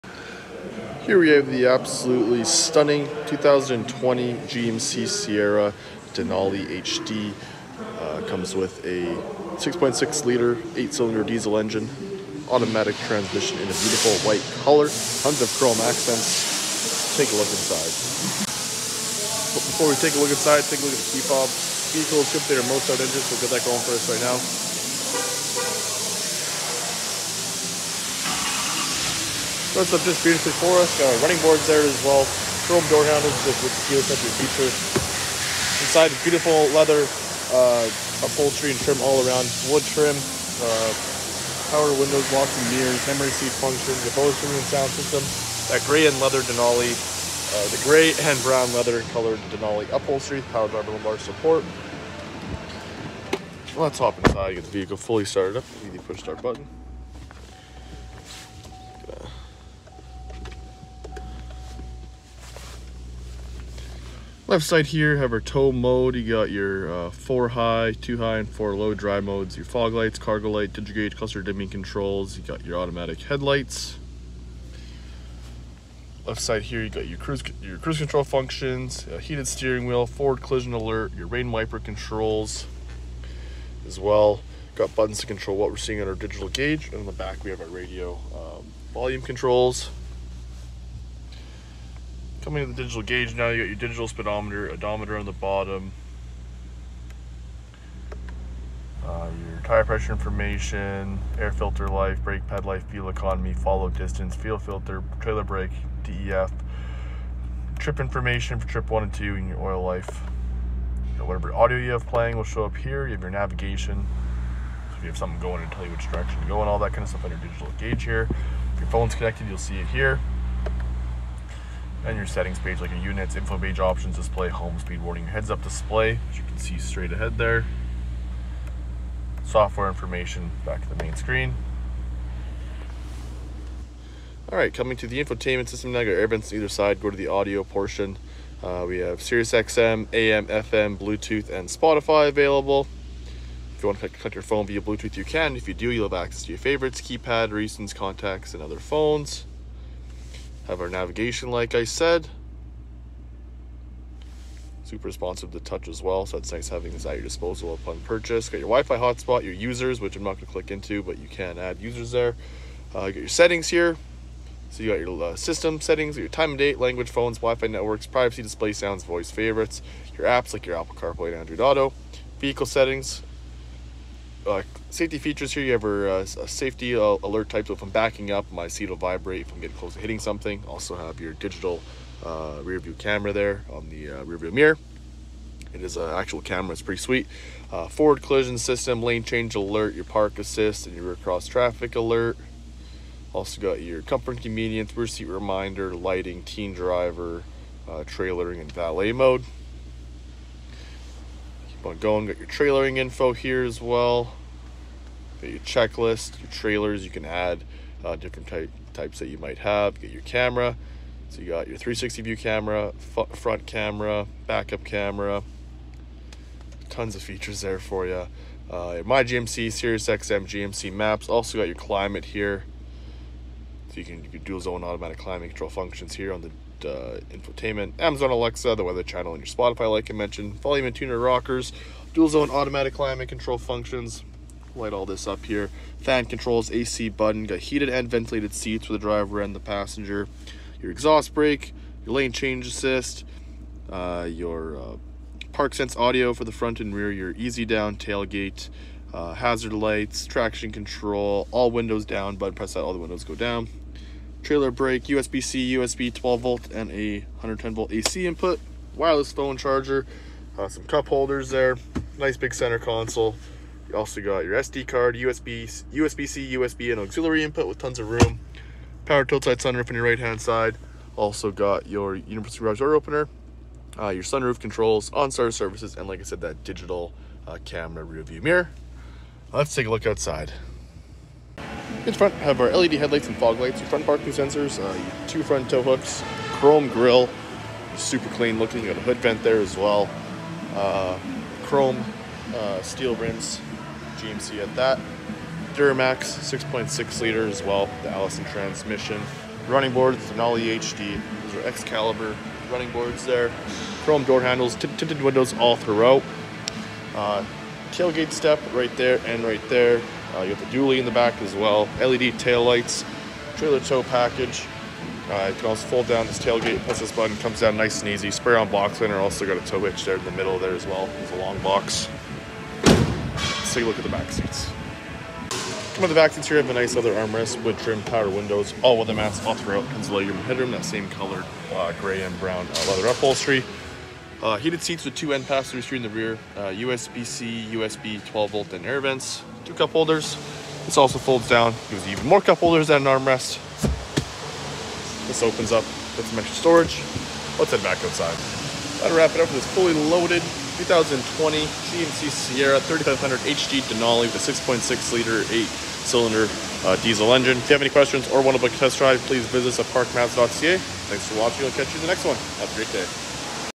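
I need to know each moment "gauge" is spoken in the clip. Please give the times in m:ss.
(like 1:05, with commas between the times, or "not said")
1:10, 1:26, 1:33, 1:57.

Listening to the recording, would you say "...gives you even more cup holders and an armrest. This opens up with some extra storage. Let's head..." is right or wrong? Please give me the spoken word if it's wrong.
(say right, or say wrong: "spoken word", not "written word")
right.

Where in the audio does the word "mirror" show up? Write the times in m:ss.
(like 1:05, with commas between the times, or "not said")
0:42, 3:04, 4:38.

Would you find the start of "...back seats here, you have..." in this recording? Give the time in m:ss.
5:26.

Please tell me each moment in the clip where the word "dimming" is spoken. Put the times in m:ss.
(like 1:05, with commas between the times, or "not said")
1:11.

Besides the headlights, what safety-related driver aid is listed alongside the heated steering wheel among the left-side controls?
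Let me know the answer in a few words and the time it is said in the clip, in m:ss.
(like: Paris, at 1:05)
Forward collision alert, at 1:20.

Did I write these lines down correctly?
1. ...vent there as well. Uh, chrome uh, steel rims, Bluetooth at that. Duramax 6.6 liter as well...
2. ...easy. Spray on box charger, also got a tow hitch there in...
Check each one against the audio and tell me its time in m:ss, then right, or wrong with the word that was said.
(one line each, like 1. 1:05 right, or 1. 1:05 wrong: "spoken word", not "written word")
1. 4:49 wrong: "GMC", not "Bluetooth"
2. 5:18 wrong: "liner", not "charger".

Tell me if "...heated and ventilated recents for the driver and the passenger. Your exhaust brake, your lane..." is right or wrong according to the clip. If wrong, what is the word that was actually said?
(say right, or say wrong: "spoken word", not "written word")
wrong: "seats", not "recents".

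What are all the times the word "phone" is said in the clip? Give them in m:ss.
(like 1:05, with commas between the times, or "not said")
1:58, 2:24, 2:28, 2:47, 4:19.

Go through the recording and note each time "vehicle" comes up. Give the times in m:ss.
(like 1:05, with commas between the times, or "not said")
0:21, 0:54, 2:52.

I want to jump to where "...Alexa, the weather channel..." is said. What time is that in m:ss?
3:48.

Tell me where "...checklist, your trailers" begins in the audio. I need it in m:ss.
3:25.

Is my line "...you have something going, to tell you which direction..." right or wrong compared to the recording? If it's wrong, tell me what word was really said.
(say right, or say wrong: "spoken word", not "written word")
right.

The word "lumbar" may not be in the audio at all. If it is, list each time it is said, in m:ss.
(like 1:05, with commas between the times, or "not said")
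0:50.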